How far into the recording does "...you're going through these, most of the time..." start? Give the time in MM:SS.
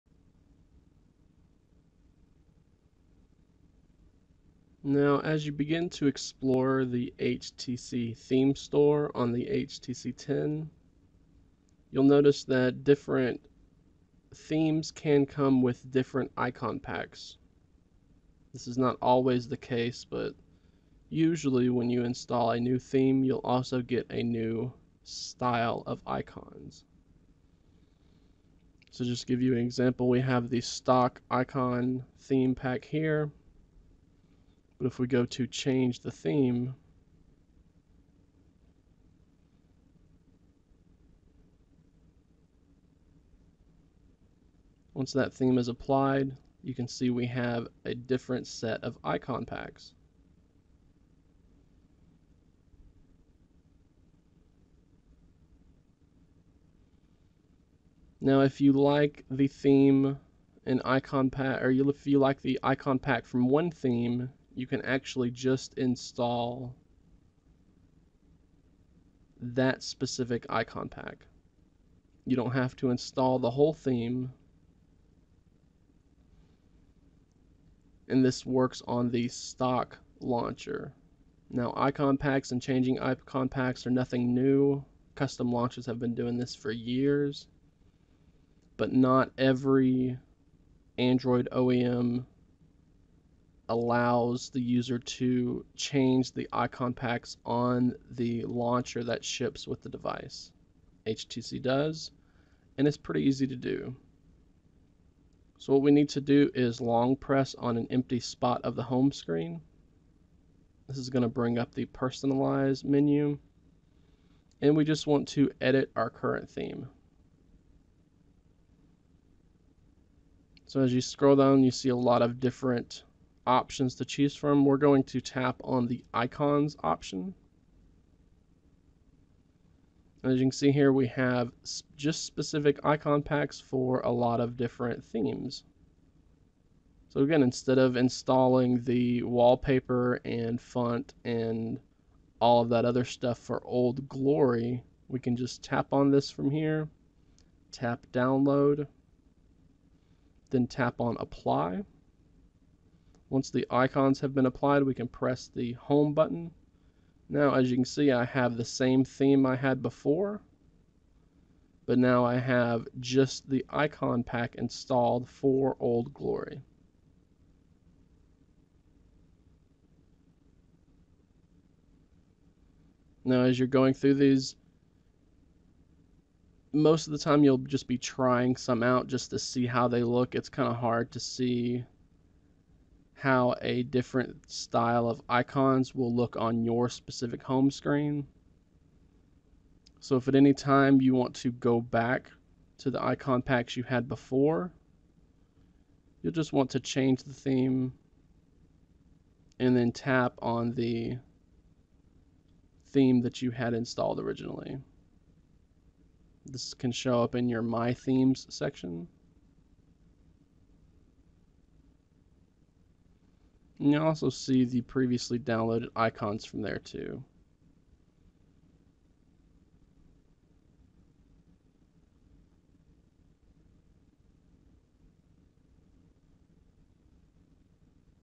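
02:53.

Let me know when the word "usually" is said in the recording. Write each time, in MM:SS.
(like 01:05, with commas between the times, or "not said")
00:21.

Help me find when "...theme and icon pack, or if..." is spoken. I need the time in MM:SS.
00:59.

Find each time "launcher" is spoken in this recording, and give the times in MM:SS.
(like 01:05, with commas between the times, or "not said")
01:20, 01:25, 01:38.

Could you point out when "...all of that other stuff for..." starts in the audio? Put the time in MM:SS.
02:22.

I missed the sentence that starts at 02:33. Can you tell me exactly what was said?
Once the icons have been applied, we can press the home button.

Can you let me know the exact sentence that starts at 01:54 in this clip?
And we just want to edit our current theme.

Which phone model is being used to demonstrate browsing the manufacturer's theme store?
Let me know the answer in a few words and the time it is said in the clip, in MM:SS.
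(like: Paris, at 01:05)
HTC 10, at 00:09.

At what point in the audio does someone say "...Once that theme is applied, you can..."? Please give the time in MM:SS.
00:44.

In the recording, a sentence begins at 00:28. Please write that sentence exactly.
So just give you an example, we have the stock icon theme pack here.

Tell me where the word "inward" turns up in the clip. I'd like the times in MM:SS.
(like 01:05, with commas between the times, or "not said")
not said.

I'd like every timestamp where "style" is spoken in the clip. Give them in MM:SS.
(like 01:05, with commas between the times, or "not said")
00:25, 03:04.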